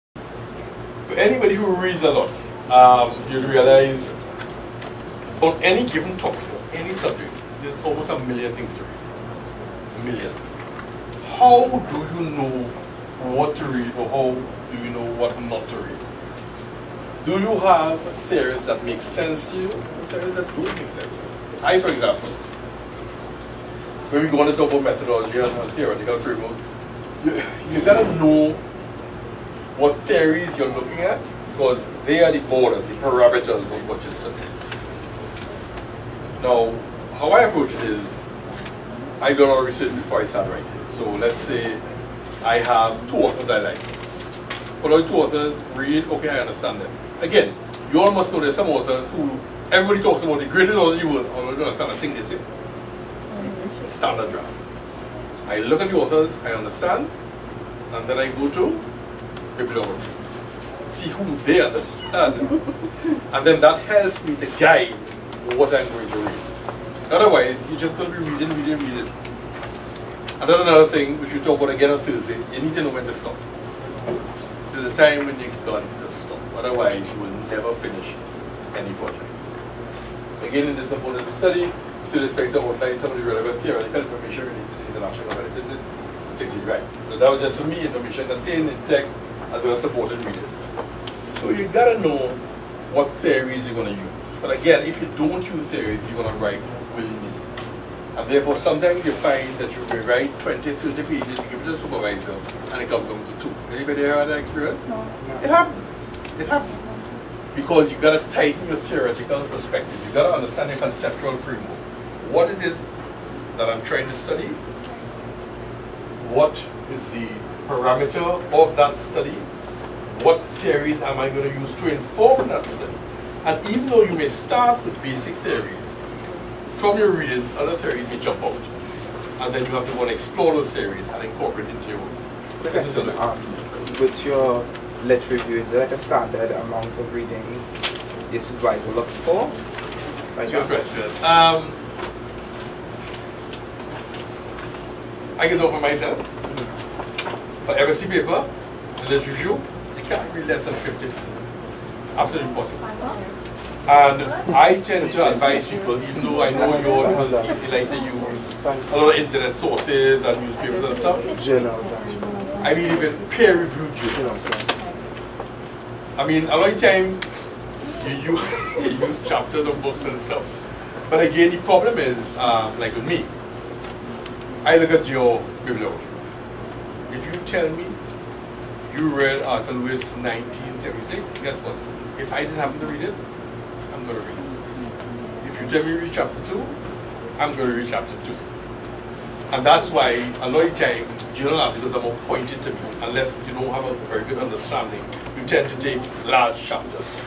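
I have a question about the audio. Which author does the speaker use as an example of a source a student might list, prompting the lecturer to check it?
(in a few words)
Arthur Lewis.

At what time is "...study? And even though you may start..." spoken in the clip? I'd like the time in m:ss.
2:02.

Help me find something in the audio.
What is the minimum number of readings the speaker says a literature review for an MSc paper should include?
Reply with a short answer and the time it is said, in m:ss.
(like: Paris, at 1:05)
50, at 2:30.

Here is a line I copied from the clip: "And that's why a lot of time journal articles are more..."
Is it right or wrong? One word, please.
right.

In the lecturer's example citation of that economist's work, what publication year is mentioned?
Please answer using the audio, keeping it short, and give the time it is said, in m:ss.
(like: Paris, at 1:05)
1976, at 3:00.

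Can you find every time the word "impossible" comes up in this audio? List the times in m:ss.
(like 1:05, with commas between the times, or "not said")
2:32.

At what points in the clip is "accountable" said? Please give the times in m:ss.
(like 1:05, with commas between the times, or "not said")
not said.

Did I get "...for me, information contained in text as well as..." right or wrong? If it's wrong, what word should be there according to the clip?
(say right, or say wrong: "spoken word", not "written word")
right.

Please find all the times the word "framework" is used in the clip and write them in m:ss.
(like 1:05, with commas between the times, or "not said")
0:26, 1:51.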